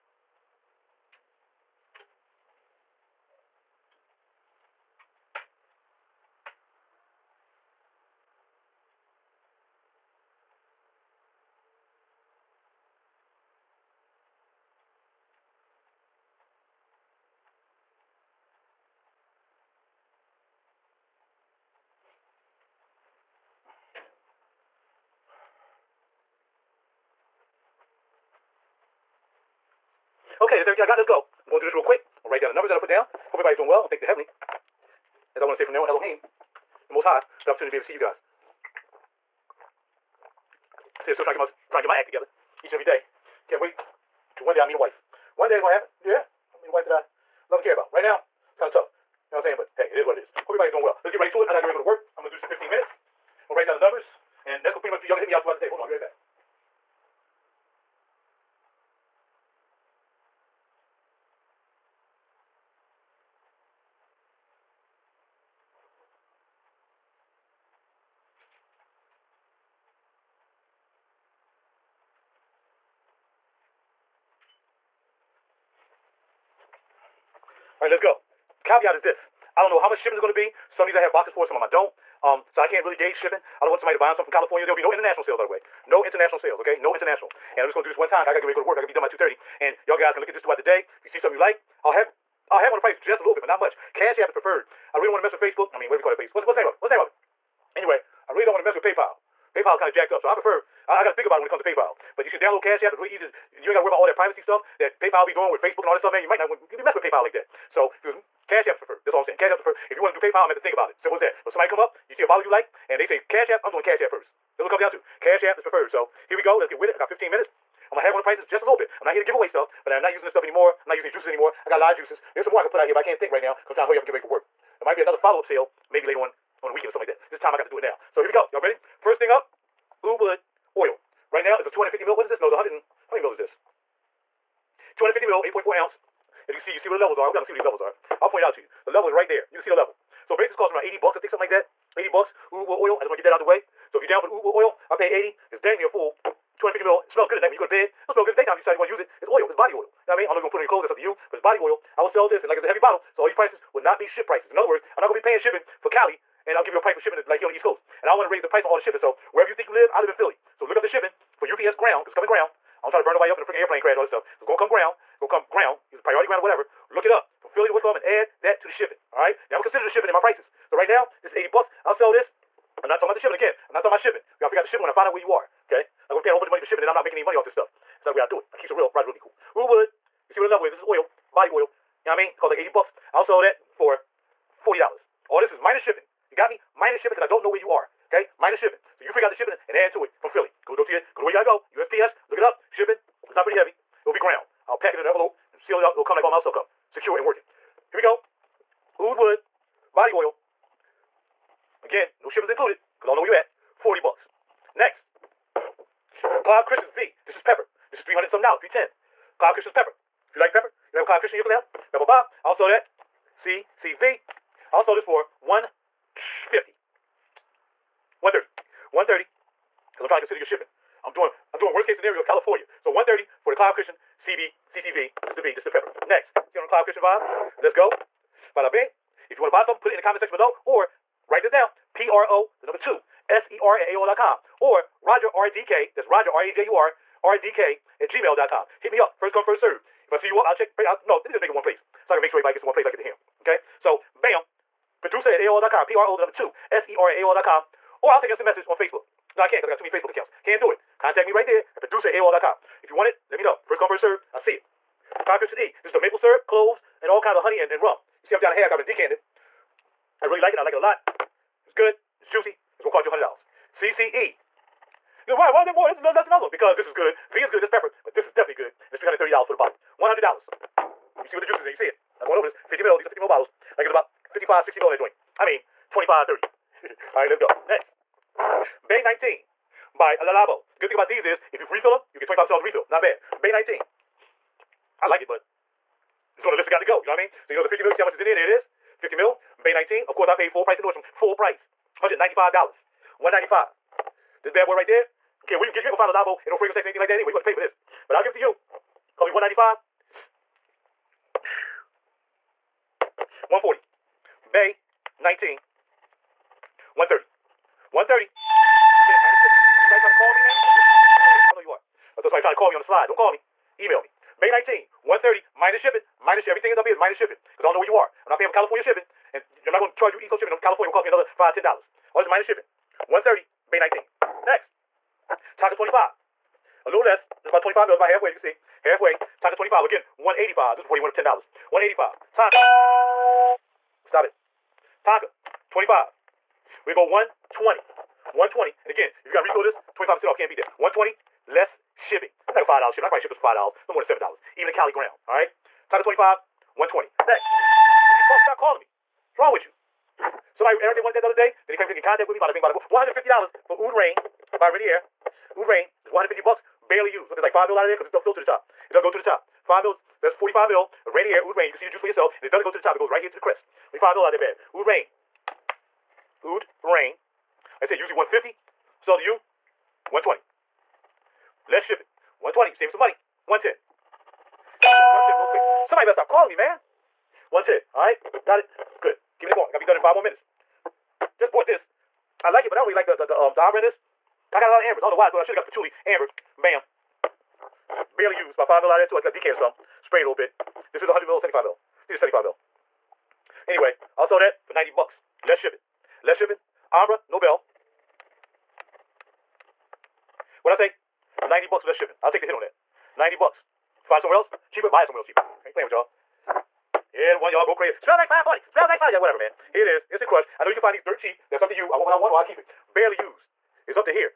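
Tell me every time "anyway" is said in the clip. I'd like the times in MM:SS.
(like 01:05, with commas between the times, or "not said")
01:37, 04:57, 06:33.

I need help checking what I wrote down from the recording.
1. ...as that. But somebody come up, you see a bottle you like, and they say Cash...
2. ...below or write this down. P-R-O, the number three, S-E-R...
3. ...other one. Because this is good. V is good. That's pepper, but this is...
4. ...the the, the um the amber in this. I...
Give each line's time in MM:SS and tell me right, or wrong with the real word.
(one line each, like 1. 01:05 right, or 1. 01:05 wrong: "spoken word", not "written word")
1. 01:51 right
2. 03:50 wrong: "two", not "three"
3. 04:26 right
4. 06:23 right.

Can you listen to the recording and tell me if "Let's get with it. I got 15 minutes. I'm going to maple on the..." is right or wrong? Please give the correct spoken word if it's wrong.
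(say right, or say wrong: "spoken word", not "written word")
wrong: "haggle", not "maple".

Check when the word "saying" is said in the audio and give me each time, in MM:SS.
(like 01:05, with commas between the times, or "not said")
00:49, 01:49.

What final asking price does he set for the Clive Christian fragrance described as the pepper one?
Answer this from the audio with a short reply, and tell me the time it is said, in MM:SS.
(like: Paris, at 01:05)
$130, at 03:42.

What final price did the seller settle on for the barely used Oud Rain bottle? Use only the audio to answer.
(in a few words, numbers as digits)
$110.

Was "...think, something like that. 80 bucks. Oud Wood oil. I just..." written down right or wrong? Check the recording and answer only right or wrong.
right.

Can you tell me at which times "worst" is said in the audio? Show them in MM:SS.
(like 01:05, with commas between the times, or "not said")
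03:41.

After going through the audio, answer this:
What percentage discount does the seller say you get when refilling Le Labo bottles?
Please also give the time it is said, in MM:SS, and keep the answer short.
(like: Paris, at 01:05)
25%, at 04:42.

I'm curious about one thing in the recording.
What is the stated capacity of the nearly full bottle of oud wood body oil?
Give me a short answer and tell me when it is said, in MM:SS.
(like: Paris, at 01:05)
250 ml, at 02:14.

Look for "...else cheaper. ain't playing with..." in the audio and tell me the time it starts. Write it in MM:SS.
06:45.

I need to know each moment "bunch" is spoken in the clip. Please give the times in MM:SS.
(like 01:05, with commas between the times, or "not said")
02:56.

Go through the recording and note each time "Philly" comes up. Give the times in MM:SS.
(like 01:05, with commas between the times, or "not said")
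02:40, 02:47, 03:10.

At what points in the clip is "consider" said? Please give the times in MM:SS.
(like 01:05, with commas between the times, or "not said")
02:49, 03:40.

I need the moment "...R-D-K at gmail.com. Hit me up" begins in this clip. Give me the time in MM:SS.
03:57.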